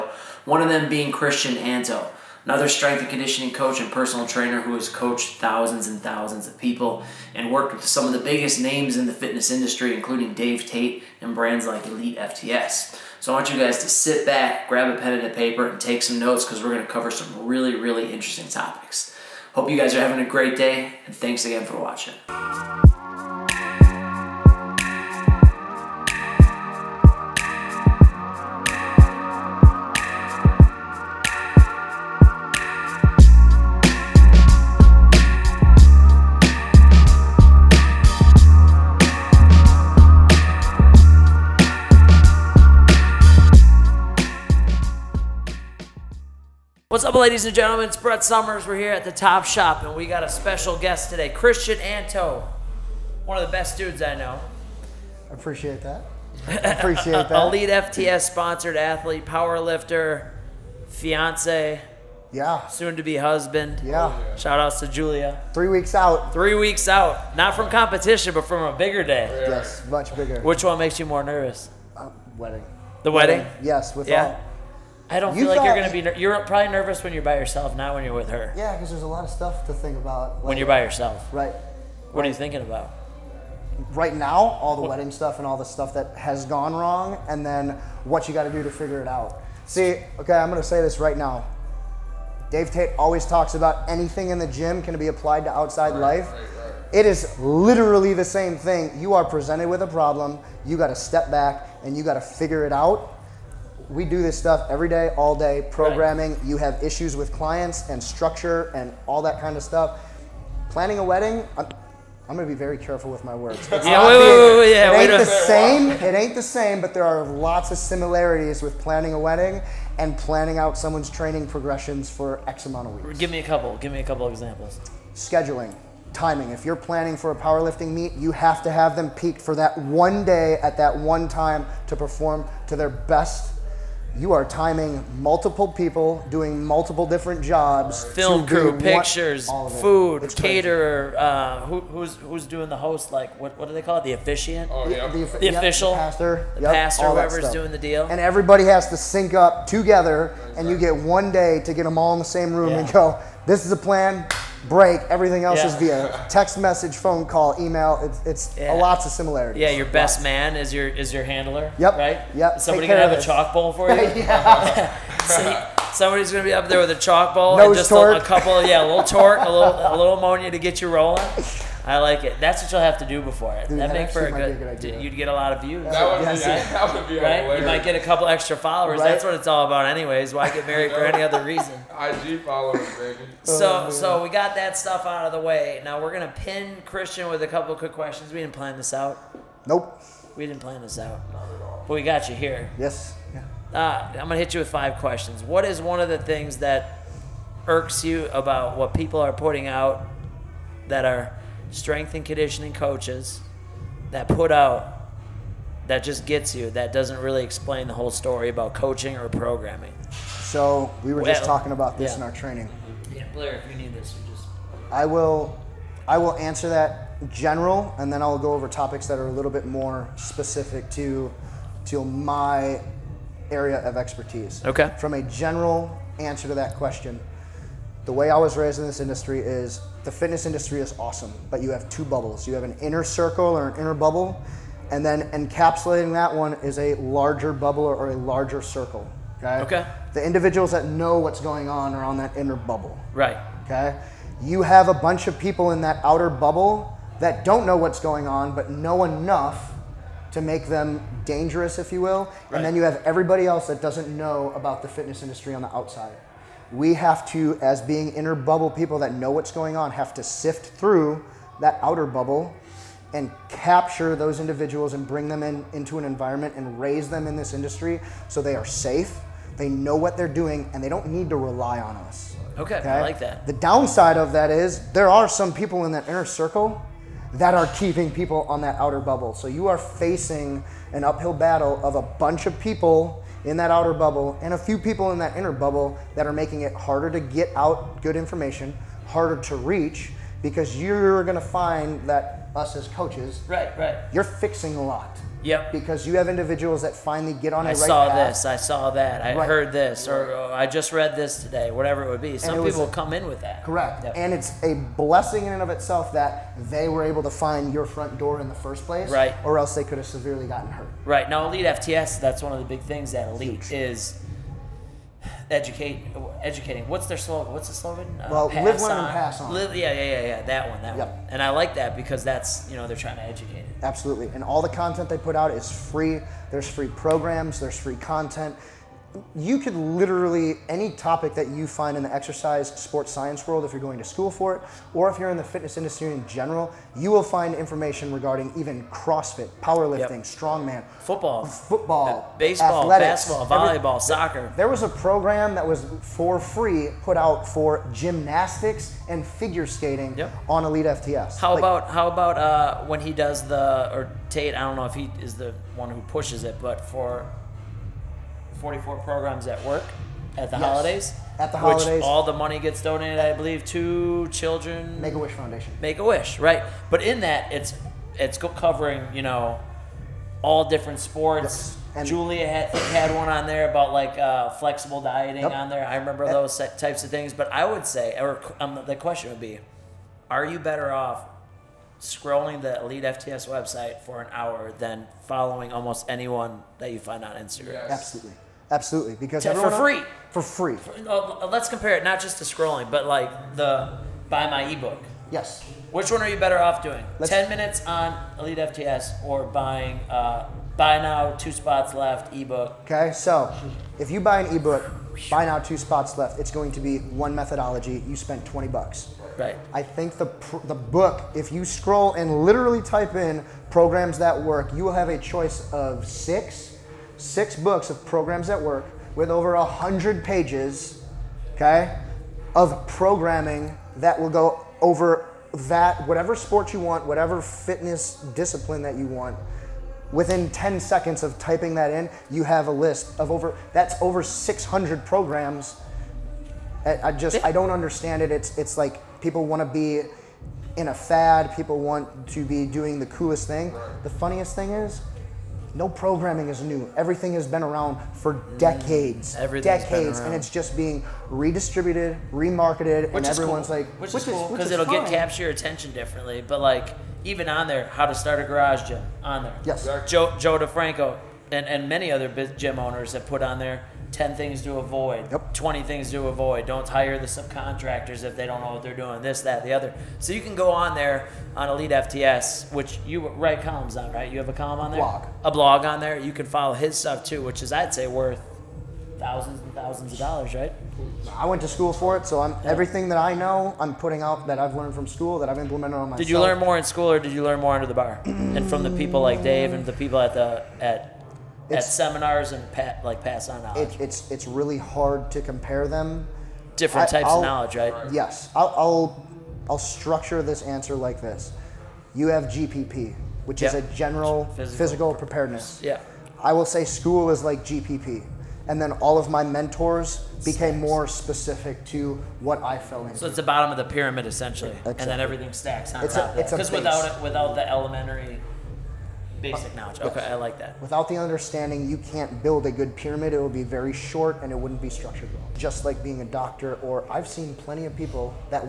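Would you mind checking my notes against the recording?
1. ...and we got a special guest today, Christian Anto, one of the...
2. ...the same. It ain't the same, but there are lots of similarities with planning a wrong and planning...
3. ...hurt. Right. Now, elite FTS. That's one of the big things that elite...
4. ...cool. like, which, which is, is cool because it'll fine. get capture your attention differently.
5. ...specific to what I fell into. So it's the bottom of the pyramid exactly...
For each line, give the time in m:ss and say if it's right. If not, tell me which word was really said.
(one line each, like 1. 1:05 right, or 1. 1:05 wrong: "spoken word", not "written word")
1. 0:49 right
2. 1:55 wrong: "wedding", not "wrong"
3. 5:10 right
4. 7:33 right
5. 8:31 wrong: "essentially", not "exactly".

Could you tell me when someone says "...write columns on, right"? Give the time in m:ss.
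7:53.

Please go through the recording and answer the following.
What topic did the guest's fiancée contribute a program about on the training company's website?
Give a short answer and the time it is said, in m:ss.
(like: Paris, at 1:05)
Flexible dieting, at 6:14.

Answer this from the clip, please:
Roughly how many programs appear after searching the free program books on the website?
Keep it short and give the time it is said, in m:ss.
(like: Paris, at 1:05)
Over 600, at 7:13.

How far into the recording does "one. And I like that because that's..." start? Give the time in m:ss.
5:21.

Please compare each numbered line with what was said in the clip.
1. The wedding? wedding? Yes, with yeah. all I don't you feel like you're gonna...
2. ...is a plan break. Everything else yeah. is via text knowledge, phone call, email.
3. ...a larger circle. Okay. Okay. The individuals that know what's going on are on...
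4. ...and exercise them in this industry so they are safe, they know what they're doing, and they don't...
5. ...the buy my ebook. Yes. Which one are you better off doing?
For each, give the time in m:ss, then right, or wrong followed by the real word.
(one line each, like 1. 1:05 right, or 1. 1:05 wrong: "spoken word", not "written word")
1. 1:13 right
2. 2:33 wrong: "message", not "knowledge"
3. 3:58 right
4. 4:26 wrong: "raise", not "exercise"
5. 6:33 right.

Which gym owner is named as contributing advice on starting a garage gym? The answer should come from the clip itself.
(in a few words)
Joe DeFranco.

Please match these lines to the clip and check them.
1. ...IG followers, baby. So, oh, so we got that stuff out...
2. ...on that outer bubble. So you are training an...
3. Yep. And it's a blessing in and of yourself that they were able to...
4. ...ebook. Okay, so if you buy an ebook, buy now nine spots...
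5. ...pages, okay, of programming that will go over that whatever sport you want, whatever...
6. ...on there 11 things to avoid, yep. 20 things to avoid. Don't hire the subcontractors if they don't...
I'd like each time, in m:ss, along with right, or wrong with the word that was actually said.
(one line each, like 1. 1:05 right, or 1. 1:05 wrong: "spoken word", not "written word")
1. 3:01 right
2. 4:38 wrong: "facing", not "training"
3. 5:04 wrong: "itself", not "yourself"
4. 6:42 wrong: "two", not "nine"
5. 7:00 right
6. 7:43 wrong: "10", not "11".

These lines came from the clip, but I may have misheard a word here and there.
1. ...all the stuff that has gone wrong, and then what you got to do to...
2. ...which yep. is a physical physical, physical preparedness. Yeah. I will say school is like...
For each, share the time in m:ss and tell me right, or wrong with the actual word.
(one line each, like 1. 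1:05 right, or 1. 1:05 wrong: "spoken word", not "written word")
1. 1:25 right
2. 8:23 wrong: "general", not "physical".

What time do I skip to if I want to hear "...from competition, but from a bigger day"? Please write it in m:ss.
1:07.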